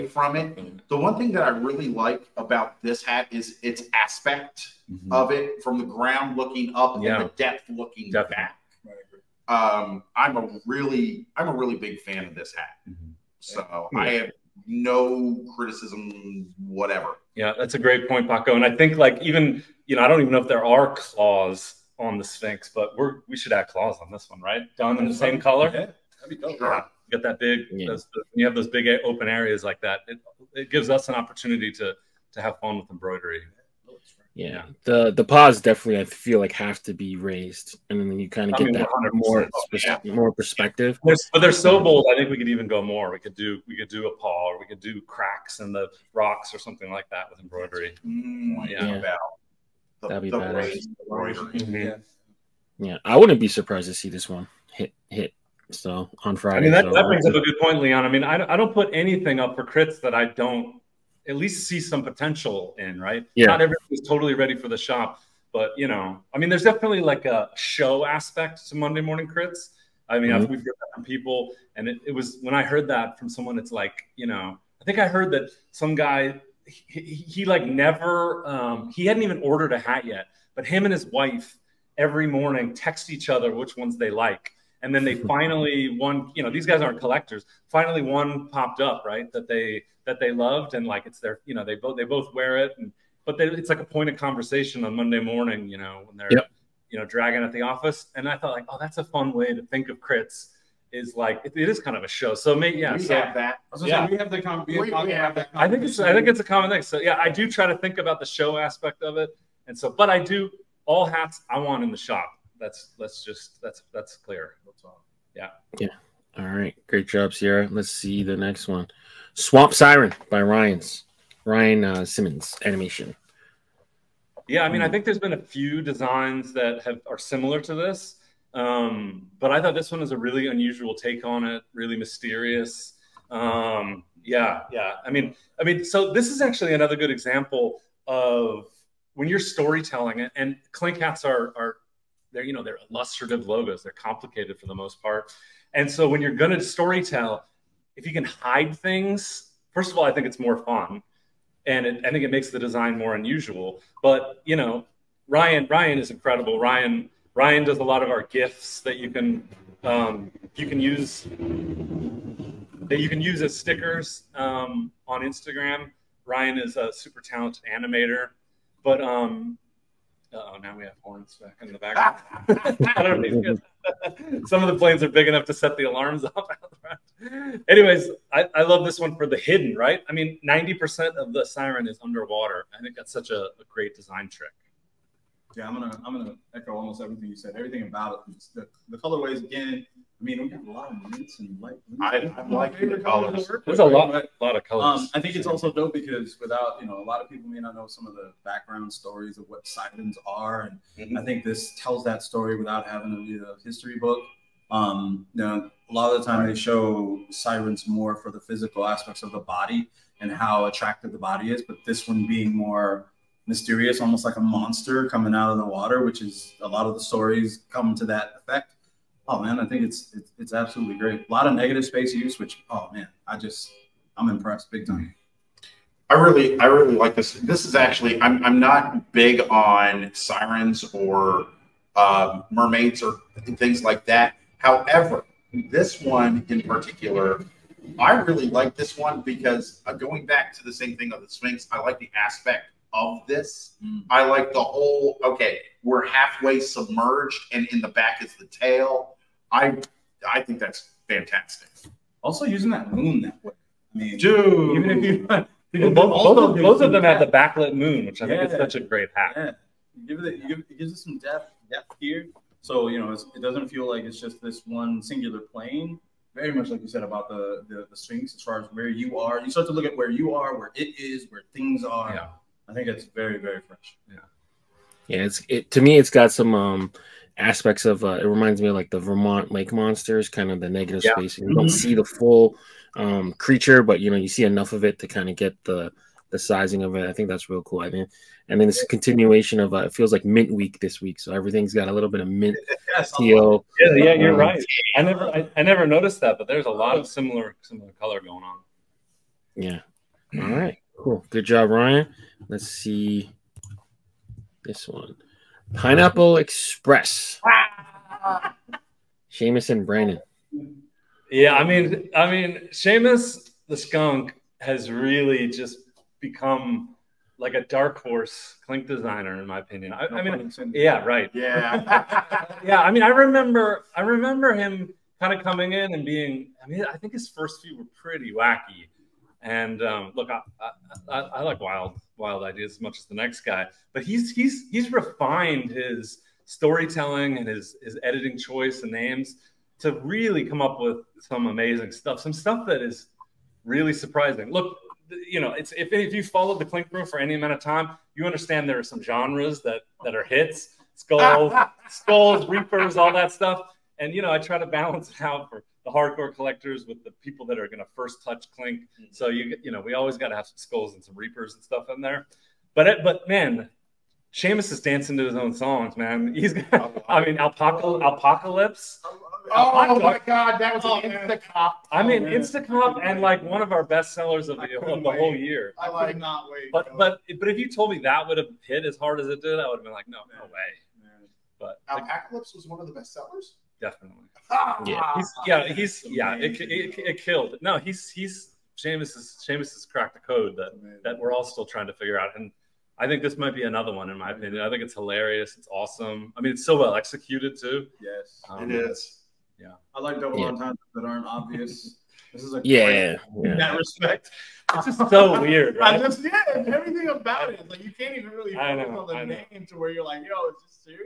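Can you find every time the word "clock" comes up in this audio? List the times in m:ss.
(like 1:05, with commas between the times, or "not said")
not said.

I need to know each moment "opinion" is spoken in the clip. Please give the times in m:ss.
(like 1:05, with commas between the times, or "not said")
5:19, 6:34.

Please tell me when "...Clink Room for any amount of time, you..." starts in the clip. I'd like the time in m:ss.
5:46.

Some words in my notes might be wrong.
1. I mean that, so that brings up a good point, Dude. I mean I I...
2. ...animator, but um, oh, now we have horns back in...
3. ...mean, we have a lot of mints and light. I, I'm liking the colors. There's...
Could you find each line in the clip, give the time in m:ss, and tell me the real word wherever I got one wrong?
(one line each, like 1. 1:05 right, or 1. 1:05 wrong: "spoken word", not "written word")
1. 0:56 wrong: "Leon", not "Dude"
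2. 2:47 right
3. 3:10 right.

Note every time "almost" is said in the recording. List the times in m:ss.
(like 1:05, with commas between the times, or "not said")
3:06, 3:33.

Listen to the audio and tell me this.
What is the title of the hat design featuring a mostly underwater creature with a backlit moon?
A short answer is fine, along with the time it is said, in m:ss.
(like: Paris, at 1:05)
Swamp Siren, at 1:59.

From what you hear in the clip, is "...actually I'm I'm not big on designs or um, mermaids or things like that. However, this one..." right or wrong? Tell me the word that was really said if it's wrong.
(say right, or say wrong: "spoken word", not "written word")
wrong: "sirens", not "designs".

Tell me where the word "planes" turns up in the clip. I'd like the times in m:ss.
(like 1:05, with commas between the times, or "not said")
2:54, 4:25.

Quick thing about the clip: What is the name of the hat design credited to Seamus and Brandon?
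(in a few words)
Pineapple Express.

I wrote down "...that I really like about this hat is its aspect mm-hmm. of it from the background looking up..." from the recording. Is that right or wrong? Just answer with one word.
wrong.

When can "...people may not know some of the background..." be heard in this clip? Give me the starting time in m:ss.
3:17.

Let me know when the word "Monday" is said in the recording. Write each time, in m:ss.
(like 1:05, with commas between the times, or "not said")
1:08, 1:34.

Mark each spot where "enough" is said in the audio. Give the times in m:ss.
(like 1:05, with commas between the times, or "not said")
2:55, 4:44.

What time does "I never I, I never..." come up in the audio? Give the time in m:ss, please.
4:54.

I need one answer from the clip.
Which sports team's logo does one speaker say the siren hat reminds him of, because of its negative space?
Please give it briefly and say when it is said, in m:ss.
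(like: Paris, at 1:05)
Vermont Lake Monsters, at 4:38.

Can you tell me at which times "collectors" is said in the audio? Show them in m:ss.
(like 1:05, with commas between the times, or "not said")
1:26, 5:56.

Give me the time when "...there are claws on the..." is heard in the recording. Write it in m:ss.
0:20.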